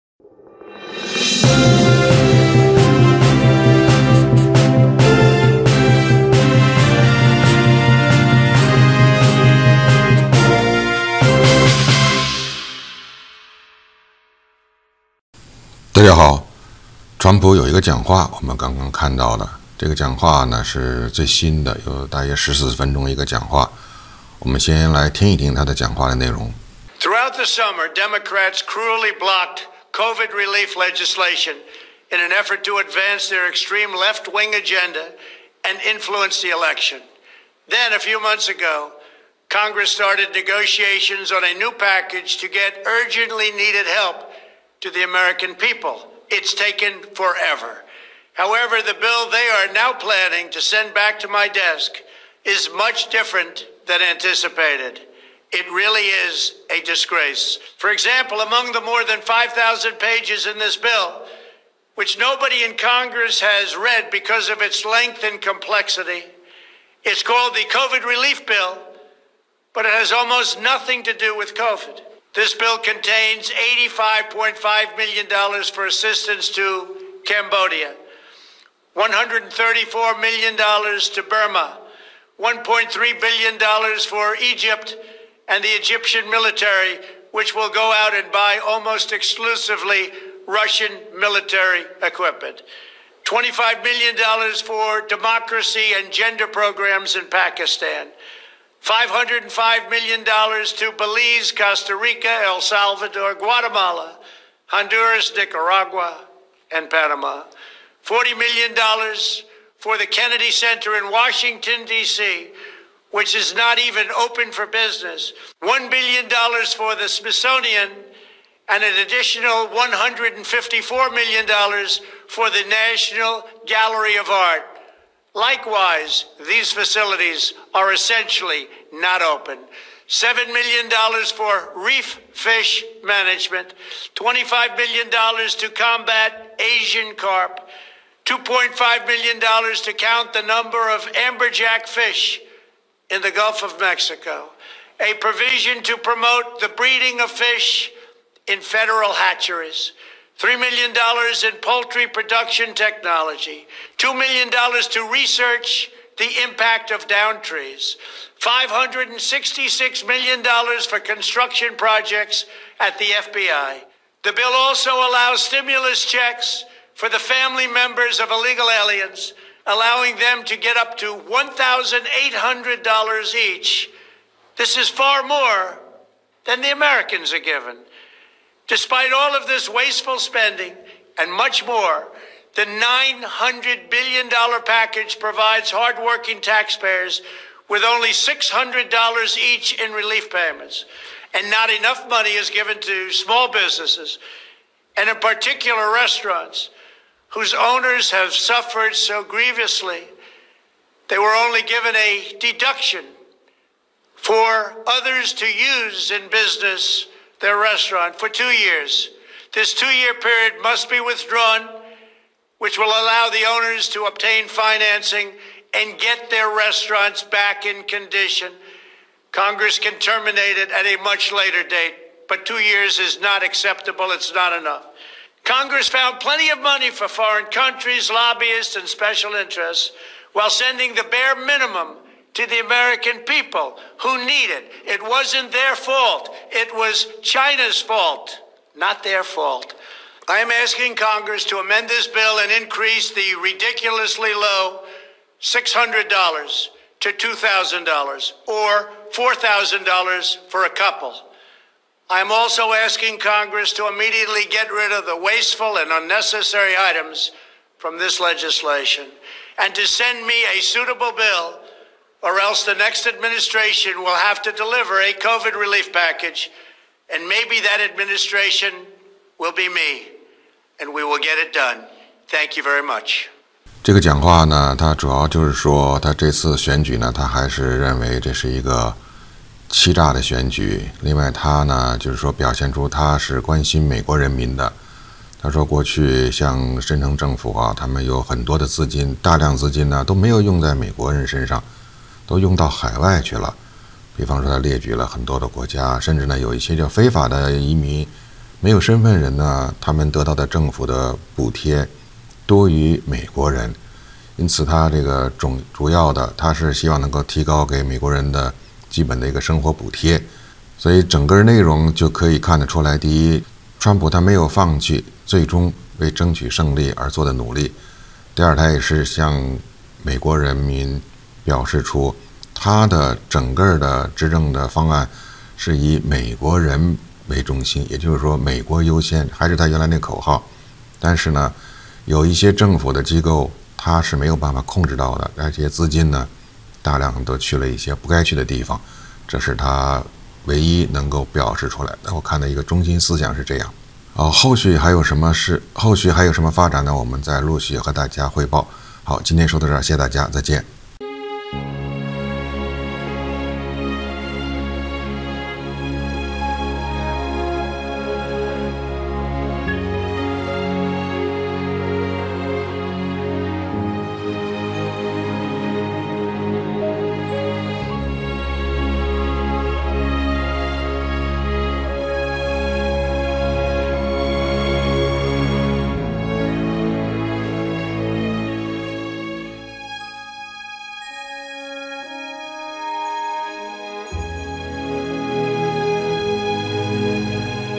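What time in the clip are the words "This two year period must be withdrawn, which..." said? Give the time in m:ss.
3:29.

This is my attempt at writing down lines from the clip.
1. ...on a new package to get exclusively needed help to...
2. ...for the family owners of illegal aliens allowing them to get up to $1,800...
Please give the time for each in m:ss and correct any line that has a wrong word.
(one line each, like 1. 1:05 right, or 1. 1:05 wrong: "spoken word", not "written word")
1. 0:41 wrong: "urgently", not "exclusively"
2. 2:46 wrong: "members", not "owners".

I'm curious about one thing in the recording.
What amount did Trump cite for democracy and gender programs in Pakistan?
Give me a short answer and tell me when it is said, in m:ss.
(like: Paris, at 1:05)
$25 million, at 1:33.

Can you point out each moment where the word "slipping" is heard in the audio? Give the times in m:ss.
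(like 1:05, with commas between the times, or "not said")
not said.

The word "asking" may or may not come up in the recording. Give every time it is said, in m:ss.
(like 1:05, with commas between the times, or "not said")
4:00, 4:12.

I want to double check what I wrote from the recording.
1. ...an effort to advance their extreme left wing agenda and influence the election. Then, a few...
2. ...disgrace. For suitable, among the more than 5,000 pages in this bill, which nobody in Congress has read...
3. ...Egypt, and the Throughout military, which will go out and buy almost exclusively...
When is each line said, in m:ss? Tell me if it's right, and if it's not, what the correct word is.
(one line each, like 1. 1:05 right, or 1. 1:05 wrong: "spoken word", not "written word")
1. 0:32 right
2. 0:56 wrong: "example", not "suitable"
3. 1:24 wrong: "Egyptian", not "Throughout".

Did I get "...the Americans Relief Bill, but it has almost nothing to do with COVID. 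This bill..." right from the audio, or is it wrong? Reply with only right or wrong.
wrong.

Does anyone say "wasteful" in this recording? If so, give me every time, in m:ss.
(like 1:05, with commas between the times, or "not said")
2:59, 4:15.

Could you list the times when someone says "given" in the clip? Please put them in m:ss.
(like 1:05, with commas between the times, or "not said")
2:57, 3:12, 3:21.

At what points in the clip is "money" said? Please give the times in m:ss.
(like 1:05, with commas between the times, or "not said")
3:12, 3:46.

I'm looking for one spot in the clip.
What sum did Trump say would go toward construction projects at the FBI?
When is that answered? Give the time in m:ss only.
2:38.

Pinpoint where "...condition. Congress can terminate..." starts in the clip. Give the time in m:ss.
3:37.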